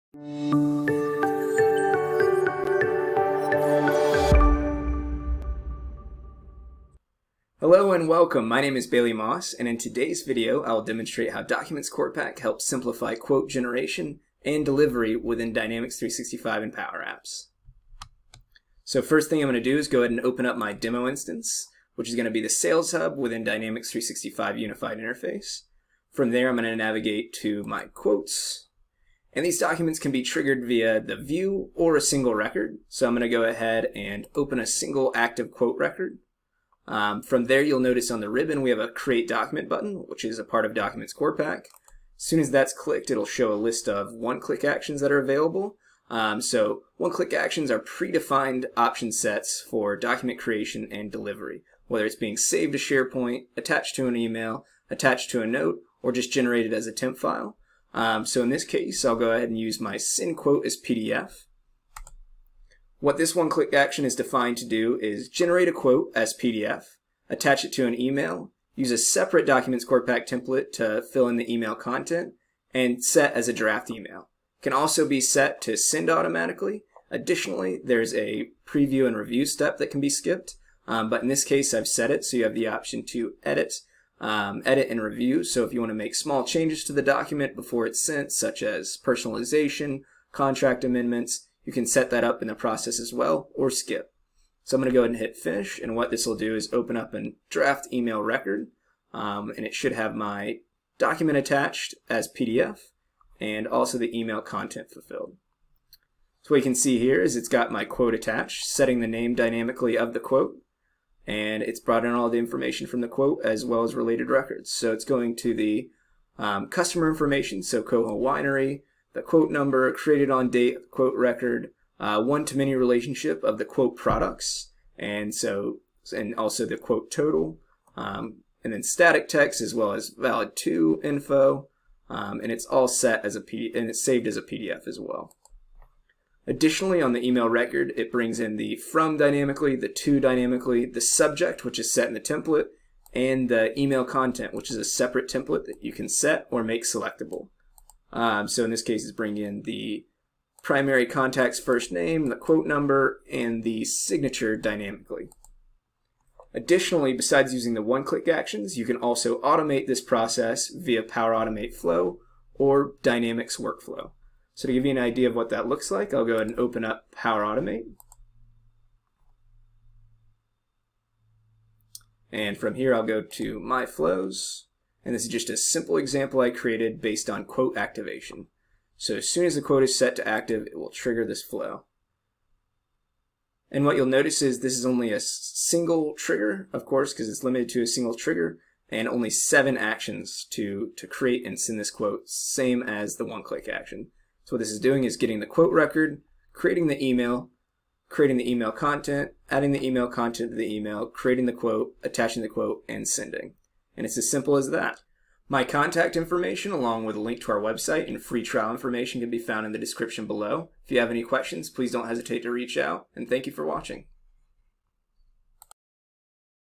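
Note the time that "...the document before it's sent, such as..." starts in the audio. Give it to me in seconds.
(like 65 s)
86 s.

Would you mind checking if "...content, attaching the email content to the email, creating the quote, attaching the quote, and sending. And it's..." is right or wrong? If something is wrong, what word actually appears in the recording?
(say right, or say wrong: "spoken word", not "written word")
wrong: "adding", not "attaching".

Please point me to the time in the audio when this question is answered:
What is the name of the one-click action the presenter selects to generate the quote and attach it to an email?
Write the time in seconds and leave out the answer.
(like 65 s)
59 s.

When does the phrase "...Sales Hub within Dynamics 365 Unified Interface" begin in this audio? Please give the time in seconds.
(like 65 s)
22 s.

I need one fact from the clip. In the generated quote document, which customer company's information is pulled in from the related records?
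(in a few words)
Coho Winery.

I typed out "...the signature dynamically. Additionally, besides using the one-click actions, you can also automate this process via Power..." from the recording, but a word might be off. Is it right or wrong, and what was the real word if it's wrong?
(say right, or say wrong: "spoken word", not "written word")
right.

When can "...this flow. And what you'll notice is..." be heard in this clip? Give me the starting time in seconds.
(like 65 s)
181 s.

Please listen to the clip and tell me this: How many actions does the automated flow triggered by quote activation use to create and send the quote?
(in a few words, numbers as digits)
7.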